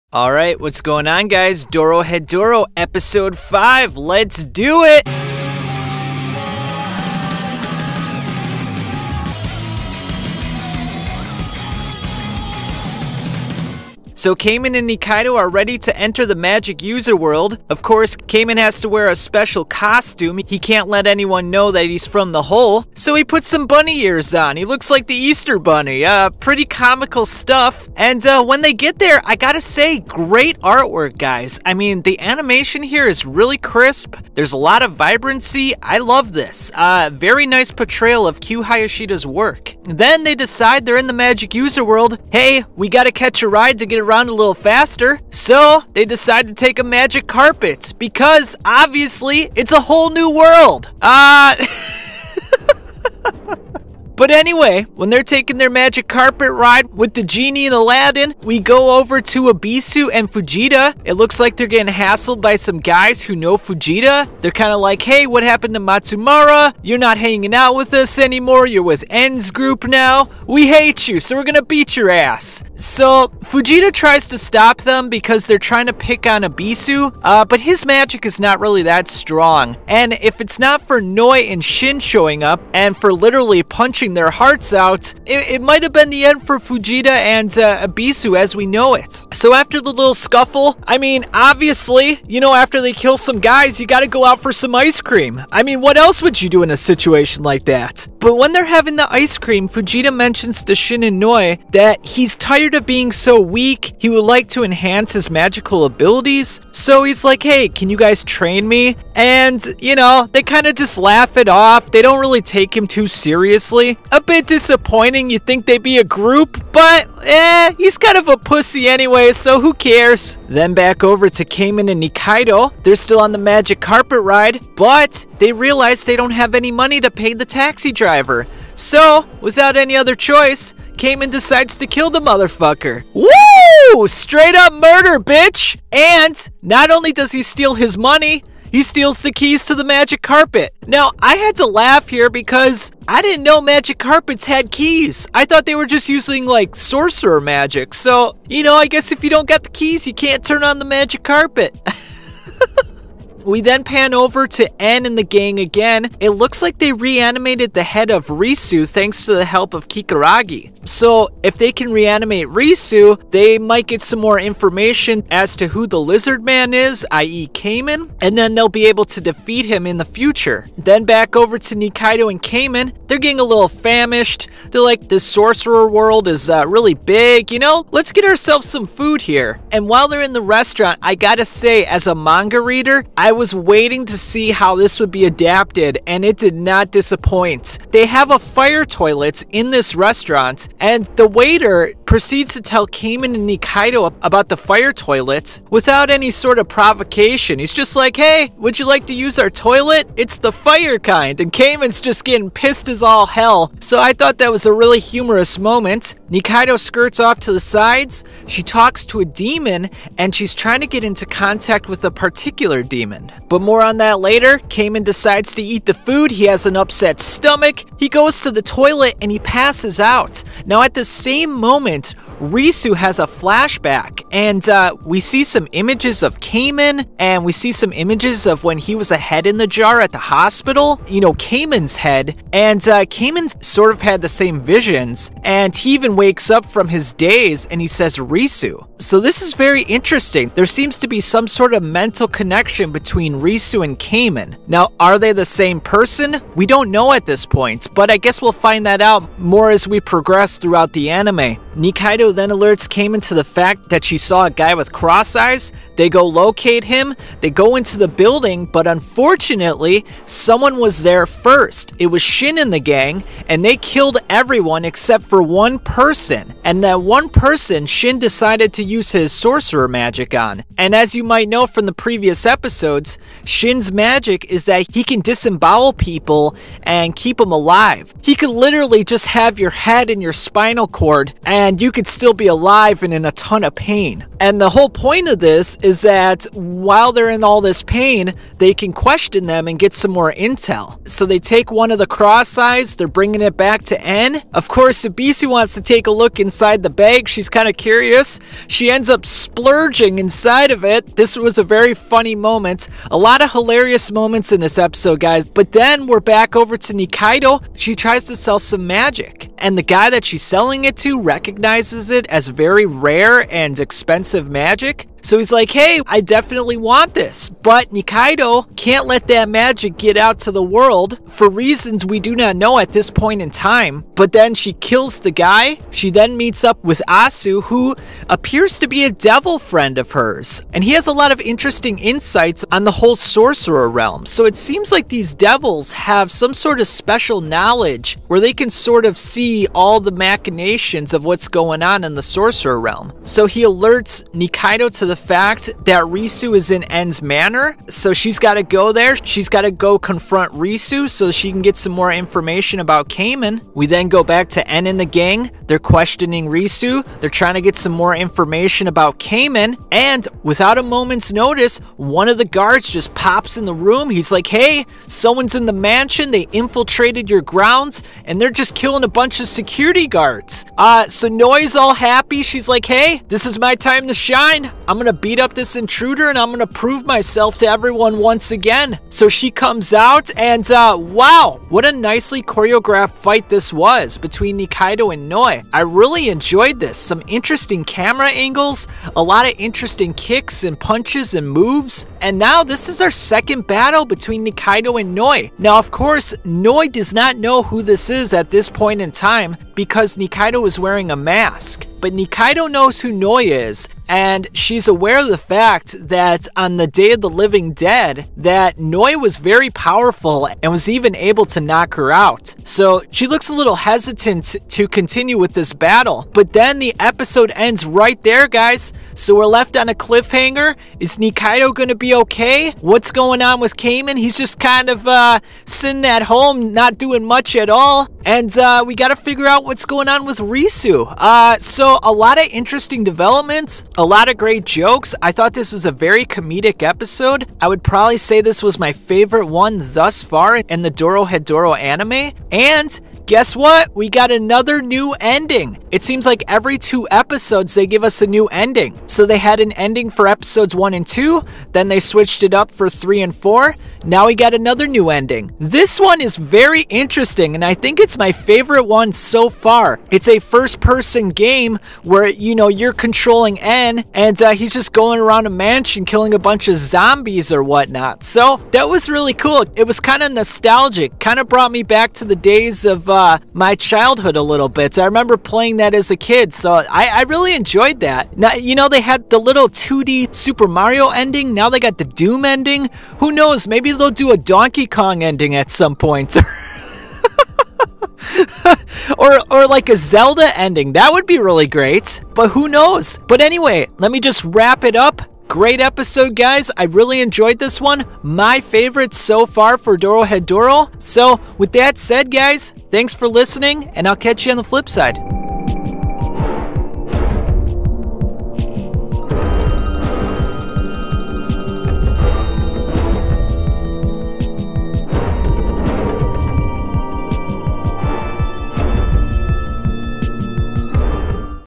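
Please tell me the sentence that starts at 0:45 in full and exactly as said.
So they decide to take a magic carpet because obviously it's a whole new world.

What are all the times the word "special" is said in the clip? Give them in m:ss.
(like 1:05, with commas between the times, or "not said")
0:19, 5:36.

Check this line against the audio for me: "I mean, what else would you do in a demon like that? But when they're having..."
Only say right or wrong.
wrong.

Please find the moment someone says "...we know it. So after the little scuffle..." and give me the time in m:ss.
1:28.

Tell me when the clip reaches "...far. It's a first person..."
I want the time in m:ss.
7:39.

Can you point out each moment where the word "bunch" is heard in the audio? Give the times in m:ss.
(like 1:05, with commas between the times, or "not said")
6:09, 7:46.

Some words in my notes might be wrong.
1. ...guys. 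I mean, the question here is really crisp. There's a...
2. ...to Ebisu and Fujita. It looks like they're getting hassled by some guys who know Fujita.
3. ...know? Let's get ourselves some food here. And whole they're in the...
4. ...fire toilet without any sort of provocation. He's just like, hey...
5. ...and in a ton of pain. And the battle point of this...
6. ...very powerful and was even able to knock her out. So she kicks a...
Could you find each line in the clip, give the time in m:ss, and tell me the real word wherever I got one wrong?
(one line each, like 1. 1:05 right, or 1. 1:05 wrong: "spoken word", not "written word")
1. 0:31 wrong: "animation", not "question"
2. 0:59 right
3. 2:57 wrong: "while", not "whole"
4. 3:14 right
5. 4:43 wrong: "whole", not "battle"
6. 6:49 wrong: "looks", not "kicks".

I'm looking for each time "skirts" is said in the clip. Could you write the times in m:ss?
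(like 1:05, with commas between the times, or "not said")
3:26.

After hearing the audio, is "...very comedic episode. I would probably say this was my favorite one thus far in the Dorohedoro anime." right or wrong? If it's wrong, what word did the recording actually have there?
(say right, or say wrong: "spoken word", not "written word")
right.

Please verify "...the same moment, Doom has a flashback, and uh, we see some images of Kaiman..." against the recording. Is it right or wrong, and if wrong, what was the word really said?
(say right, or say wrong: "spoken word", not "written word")
wrong: "Risu", not "Doom".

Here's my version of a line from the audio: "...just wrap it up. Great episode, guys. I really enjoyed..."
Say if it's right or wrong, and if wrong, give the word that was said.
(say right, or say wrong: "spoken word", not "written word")
right.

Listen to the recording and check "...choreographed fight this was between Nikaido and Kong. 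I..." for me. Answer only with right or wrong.
wrong.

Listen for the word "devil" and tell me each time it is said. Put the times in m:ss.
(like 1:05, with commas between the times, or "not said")
5:29, 5:35.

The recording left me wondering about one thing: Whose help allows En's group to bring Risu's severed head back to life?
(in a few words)
Kikurage.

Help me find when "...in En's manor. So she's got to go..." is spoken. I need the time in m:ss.
5:46.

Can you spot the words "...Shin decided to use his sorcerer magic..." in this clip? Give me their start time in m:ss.
4:27.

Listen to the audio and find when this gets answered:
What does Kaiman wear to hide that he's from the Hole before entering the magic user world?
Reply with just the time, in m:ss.
0:23.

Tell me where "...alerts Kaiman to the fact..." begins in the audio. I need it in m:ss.
4:12.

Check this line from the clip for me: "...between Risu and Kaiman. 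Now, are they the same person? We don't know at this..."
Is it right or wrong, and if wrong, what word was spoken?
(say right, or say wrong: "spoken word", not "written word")
right.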